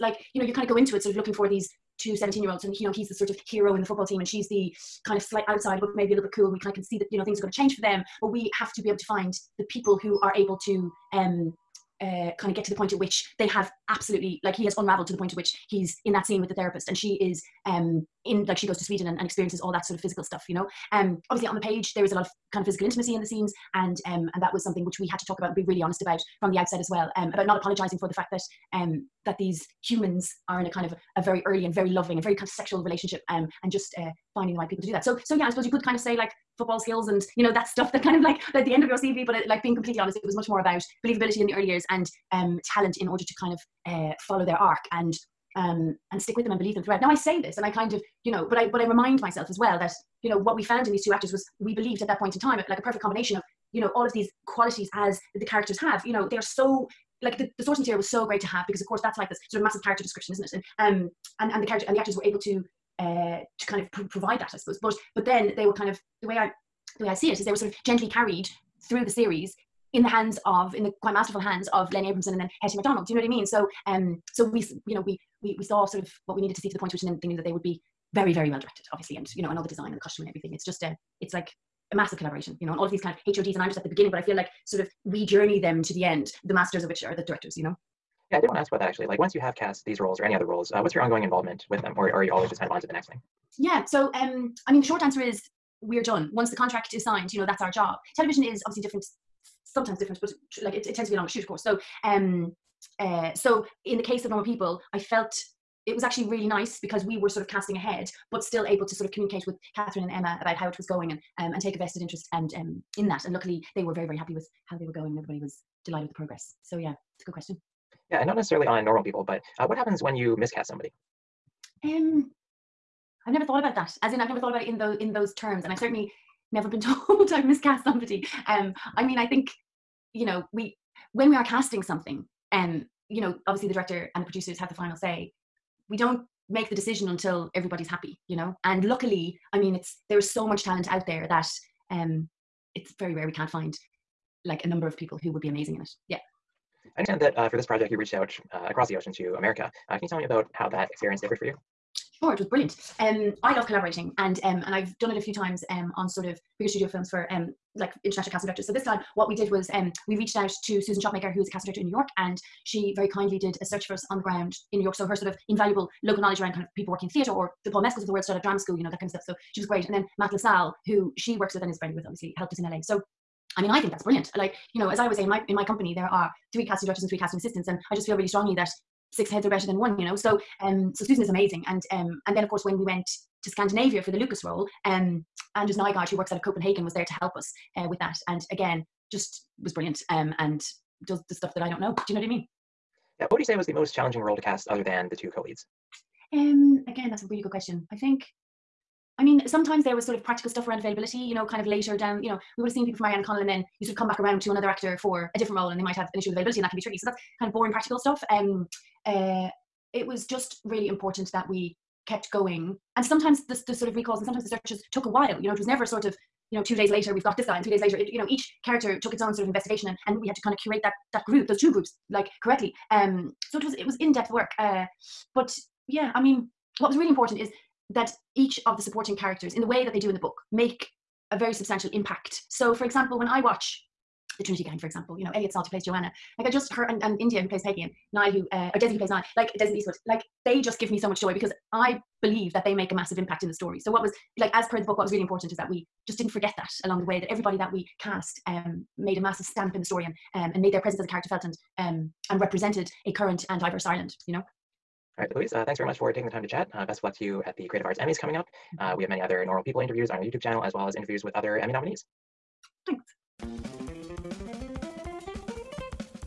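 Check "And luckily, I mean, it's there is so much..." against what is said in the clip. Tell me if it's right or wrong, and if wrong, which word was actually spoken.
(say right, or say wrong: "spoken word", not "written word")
right.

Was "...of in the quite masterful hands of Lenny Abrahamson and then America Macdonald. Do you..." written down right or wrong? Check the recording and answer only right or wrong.
wrong.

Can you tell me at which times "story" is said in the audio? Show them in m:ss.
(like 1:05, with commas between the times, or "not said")
4:03, 4:09.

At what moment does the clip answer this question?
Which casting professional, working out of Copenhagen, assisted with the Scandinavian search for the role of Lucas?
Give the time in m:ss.
3:05.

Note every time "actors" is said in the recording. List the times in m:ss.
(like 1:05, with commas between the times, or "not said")
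0:51, 1:01, 3:24.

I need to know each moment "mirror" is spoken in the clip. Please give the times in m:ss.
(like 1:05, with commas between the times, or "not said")
not said.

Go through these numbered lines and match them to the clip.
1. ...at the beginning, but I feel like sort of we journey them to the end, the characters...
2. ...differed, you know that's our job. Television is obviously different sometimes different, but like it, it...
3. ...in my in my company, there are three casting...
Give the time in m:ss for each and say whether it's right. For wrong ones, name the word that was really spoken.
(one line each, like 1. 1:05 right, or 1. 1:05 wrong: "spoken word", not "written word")
1. 1:23 wrong: "masters", not "characters"
2. 1:37 wrong: "signed", not "differed"
3. 2:55 right.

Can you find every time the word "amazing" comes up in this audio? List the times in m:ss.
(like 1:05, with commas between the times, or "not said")
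2:25, 3:01.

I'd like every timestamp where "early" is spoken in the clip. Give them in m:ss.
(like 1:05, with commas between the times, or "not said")
0:31, 0:41.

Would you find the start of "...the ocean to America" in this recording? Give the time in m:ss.
2:28.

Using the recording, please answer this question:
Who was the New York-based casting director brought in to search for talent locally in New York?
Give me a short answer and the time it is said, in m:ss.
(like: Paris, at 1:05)
Susan Shopmaker, at 2:40.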